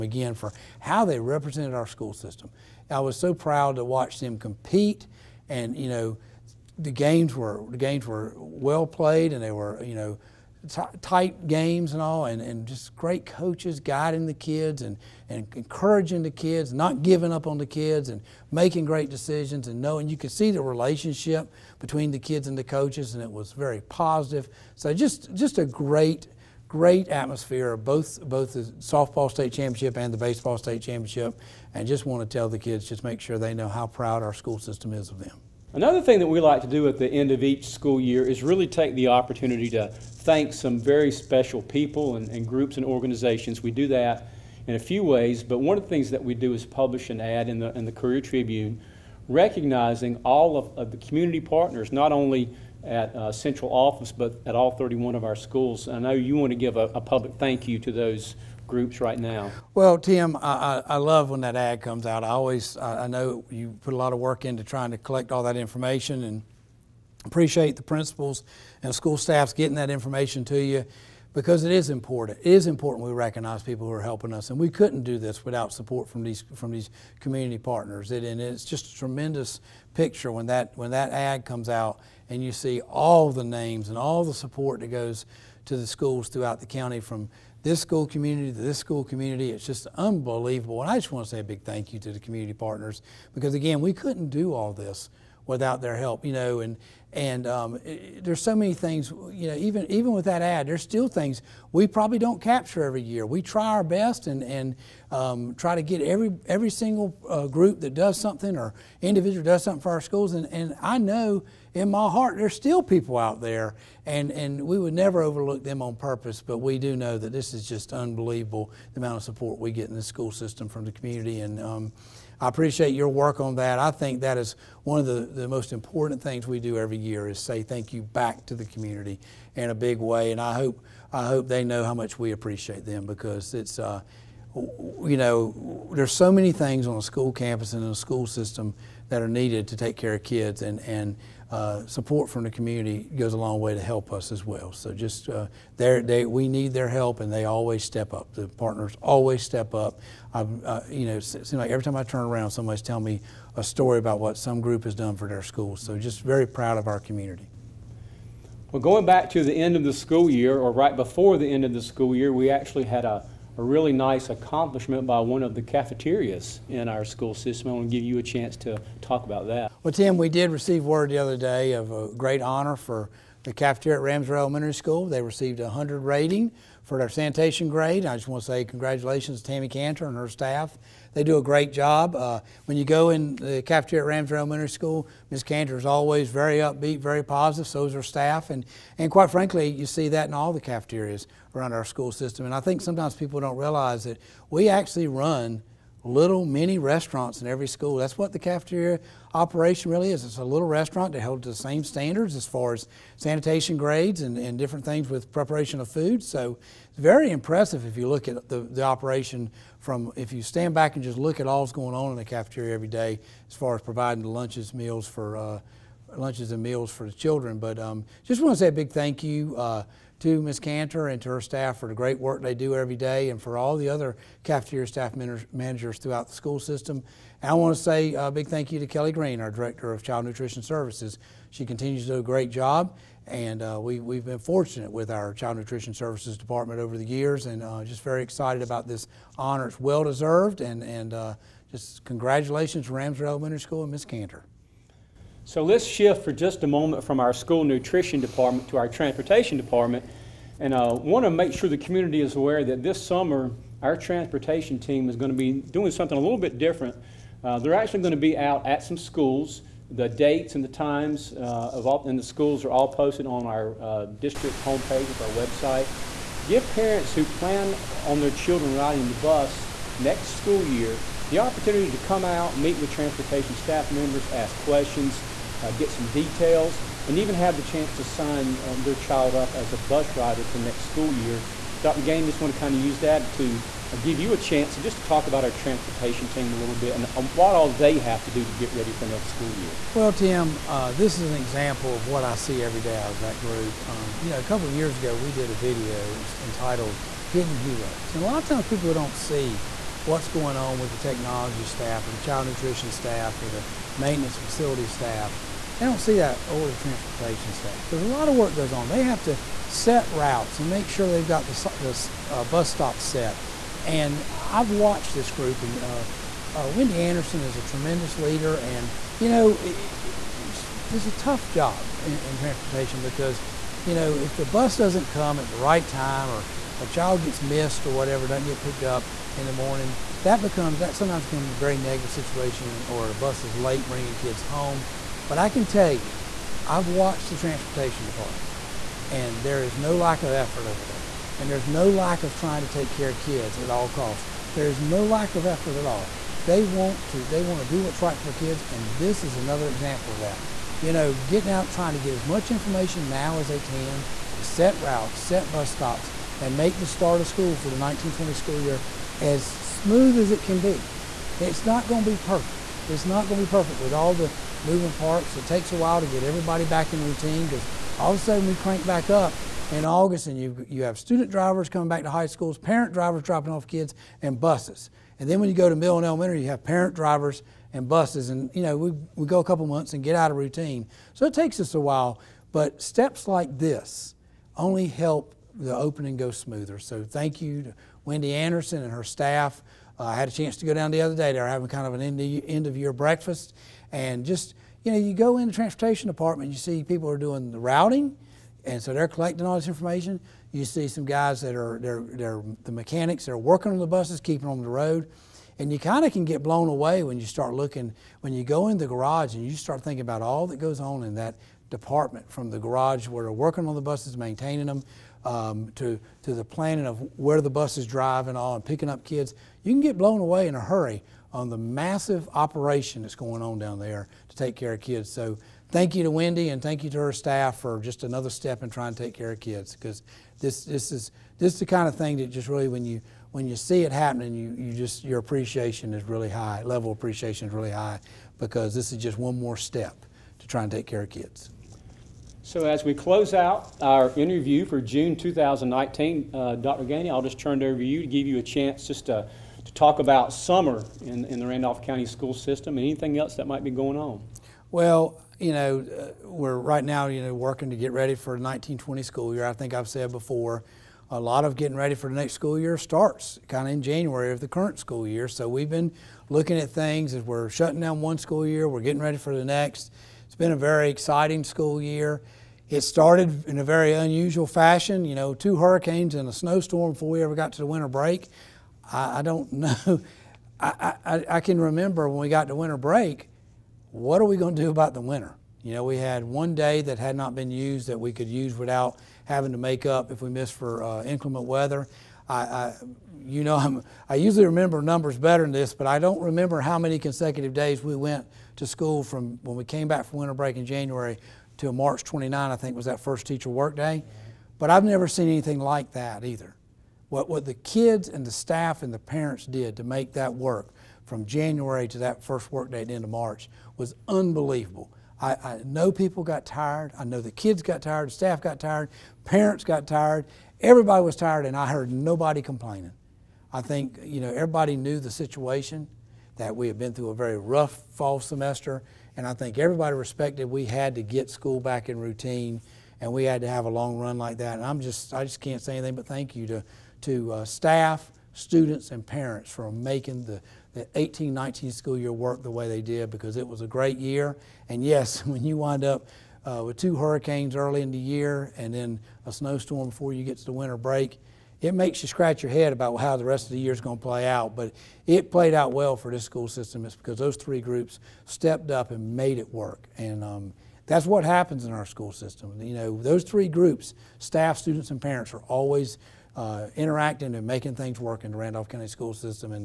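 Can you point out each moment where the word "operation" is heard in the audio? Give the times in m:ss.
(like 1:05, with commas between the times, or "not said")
3:19, 3:28, 7:02.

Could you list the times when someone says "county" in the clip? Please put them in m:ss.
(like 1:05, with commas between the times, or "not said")
1:26, 7:31, 9:28.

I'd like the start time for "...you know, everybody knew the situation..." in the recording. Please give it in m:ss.
8:44.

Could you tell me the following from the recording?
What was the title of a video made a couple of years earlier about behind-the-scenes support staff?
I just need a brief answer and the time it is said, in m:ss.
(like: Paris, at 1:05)
Hidden Heroes, at 4:57.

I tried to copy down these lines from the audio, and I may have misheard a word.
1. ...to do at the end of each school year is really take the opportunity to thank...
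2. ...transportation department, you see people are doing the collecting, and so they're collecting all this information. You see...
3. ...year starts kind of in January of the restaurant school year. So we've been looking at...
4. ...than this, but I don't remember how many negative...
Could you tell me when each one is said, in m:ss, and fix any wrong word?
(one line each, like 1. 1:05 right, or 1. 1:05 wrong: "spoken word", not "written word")
1. 0:36 right
2. 6:35 wrong: "routing", not "collecting"
3. 7:42 wrong: "current", not "restaurant"
4. 8:15 wrong: "consecutive", not "negative".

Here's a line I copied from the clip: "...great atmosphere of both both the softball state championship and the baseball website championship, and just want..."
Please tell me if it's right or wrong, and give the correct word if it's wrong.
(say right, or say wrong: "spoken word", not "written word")
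wrong: "state", not "website".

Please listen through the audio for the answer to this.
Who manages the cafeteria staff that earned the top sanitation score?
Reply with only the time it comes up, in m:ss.
2:59.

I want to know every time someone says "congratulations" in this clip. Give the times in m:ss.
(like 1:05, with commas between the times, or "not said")
2:58, 4:02.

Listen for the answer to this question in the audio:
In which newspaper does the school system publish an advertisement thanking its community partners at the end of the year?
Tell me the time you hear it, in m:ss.
0:47.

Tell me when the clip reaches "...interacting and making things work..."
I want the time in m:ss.
9:26.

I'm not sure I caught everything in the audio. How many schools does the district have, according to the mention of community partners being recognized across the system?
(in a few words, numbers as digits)
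31.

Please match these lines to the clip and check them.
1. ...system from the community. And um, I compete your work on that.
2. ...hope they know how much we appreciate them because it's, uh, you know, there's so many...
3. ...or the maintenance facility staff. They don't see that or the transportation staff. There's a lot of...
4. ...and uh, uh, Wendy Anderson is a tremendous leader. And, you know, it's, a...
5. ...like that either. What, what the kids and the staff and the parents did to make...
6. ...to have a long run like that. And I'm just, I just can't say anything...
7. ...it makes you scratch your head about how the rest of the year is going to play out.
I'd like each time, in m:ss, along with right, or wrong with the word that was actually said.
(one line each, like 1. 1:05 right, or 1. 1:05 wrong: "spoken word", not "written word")
1. 2:00 wrong: "appreciate", not "compete"
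2. 2:11 right
3. 5:03 right
4. 5:15 right
5. 8:25 right
6. 8:53 right
7. 9:11 right.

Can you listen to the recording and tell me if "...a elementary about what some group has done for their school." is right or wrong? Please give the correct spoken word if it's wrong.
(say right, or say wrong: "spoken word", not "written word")
wrong: "story", not "elementary".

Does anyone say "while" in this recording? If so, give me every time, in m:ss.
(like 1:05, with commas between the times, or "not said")
6:05, 6:21.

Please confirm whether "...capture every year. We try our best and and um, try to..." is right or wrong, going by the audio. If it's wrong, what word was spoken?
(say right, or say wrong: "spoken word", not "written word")
right.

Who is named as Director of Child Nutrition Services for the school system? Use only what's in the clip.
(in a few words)
Kelly Green.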